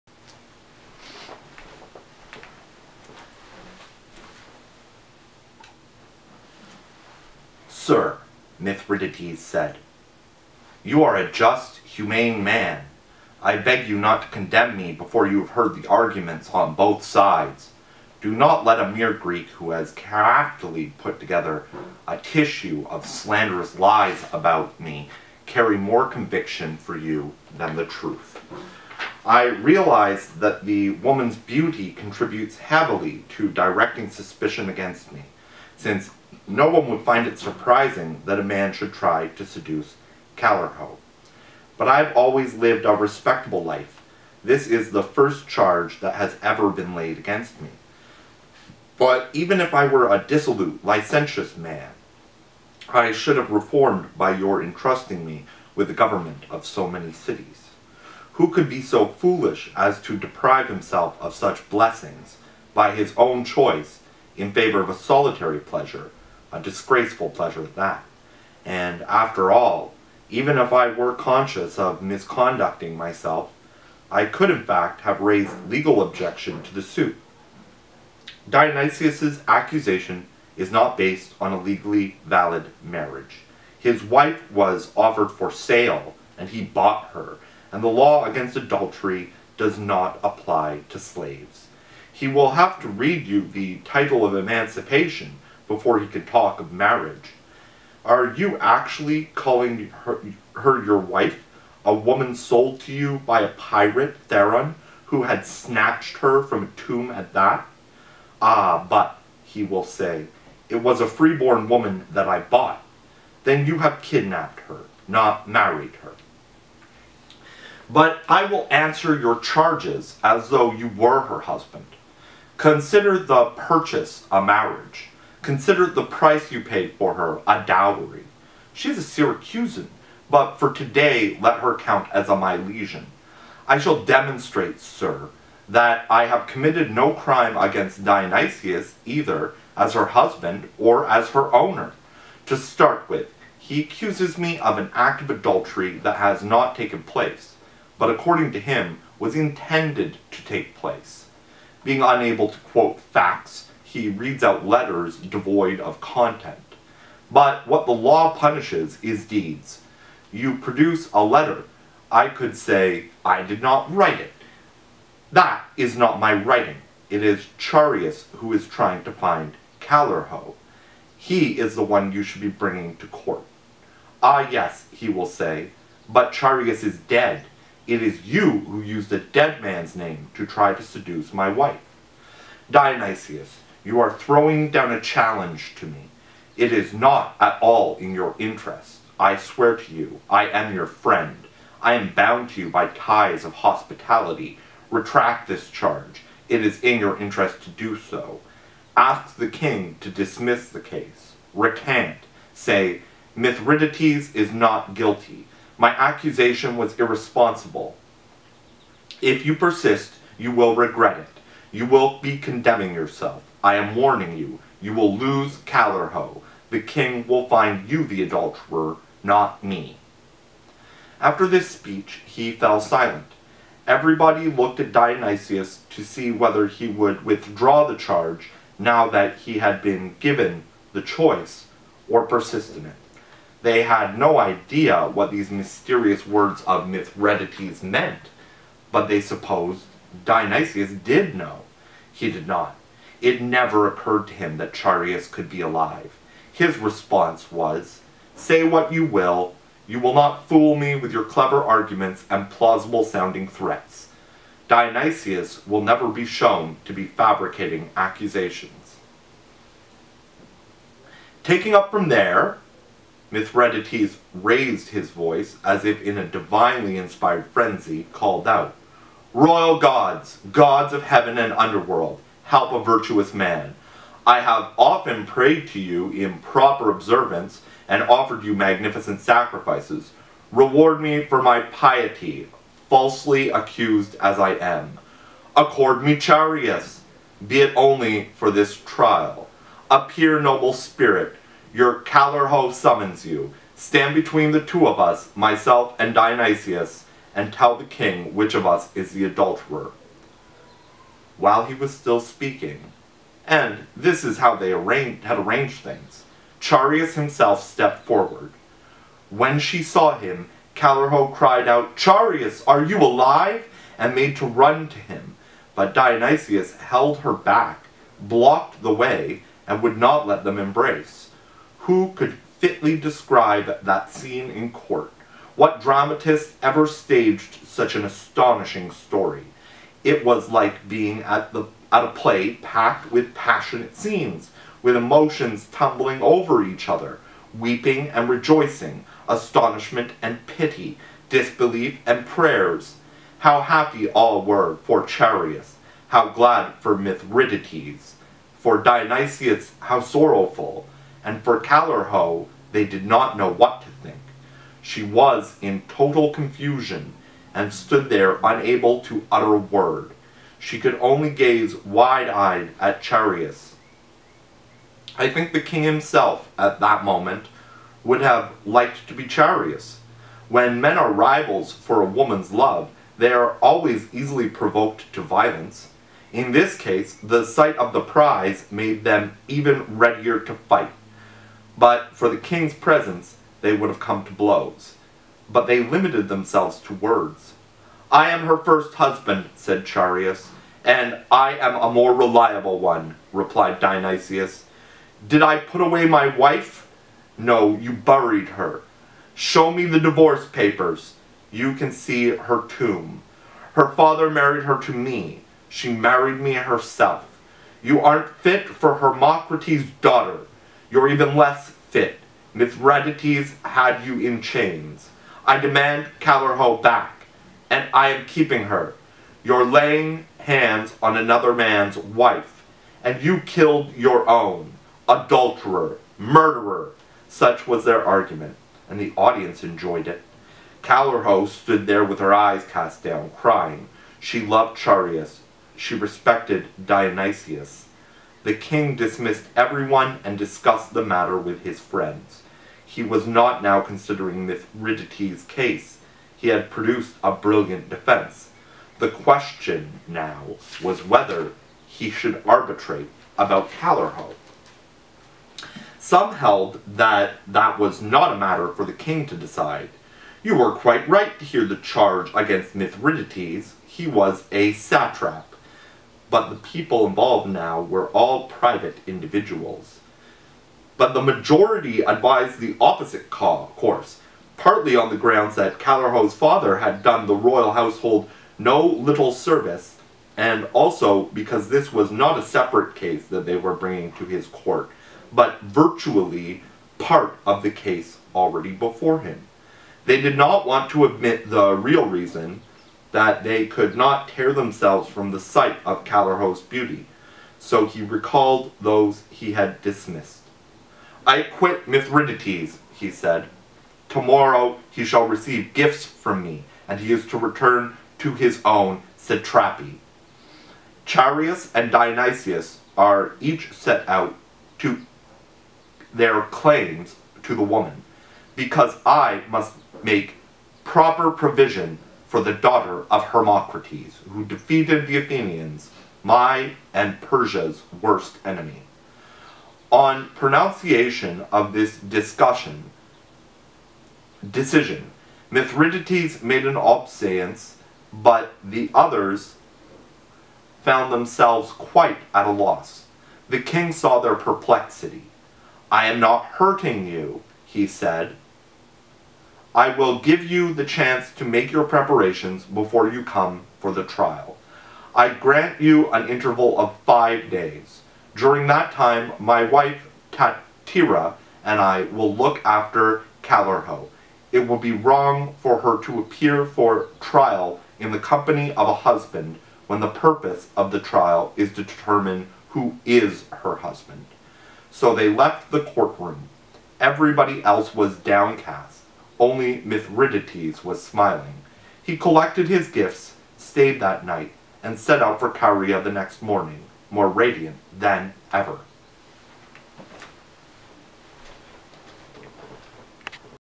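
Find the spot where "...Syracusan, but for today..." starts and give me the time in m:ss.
2:09.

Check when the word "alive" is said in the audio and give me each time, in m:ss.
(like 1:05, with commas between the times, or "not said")
4:05, 5:12.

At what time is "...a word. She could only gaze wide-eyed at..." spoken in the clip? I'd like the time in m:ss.
5:59.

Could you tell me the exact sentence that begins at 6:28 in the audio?
I am her first husband, said Chaereas, and I am a more reliable one, replied Dionysius.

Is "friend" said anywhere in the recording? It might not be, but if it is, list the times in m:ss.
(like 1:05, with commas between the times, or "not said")
3:10, 7:21.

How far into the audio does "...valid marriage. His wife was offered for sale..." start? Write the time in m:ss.
1:22.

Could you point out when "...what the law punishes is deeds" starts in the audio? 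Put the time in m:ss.
2:37.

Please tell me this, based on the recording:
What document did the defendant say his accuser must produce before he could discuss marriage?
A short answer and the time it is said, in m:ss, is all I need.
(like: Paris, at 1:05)
The title of emancipation, at 1:33.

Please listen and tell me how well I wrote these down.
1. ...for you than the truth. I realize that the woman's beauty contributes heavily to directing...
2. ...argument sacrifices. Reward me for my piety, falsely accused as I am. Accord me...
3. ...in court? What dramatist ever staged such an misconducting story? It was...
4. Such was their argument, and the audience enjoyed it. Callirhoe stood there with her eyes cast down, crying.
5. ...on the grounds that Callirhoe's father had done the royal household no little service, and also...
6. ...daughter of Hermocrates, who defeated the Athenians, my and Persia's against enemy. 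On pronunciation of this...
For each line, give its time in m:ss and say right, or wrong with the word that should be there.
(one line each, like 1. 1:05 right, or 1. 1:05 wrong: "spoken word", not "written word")
1. 0:26 right
2. 4:38 wrong: "magnificent", not "argument"
3. 5:24 wrong: "astonishing", not "misconducting"
4. 7:07 right
5. 7:54 right
6. 8:42 wrong: "worst", not "against".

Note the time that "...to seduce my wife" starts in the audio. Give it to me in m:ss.
3:00.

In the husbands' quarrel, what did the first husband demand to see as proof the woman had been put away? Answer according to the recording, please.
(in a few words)
Divorce papers.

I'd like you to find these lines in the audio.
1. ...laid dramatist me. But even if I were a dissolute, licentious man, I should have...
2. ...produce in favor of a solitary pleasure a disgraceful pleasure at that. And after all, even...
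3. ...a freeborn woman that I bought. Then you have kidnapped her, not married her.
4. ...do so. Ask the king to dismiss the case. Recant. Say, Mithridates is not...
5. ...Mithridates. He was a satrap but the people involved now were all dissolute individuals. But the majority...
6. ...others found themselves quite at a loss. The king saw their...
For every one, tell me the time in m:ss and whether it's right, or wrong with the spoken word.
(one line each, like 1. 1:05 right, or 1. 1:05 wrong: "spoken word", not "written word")
1. 0:46 wrong: "against", not "dramatist"
2. 1:03 wrong: "choice", not "produce"
3. 1:51 right
4. 3:17 right
5. 7:42 wrong: "private", not "dissolute"
6. 8:58 right.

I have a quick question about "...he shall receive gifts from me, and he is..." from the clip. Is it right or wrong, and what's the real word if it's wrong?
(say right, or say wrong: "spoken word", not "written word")
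right.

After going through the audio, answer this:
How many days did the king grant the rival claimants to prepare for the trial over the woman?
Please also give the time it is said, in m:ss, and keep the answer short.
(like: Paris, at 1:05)
5, at 9:17.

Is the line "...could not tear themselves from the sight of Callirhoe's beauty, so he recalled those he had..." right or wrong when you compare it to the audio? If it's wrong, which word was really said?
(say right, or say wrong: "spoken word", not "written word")
right.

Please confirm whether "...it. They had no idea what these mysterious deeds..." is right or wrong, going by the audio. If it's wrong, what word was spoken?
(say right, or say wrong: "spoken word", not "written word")
wrong: "words", not "deeds".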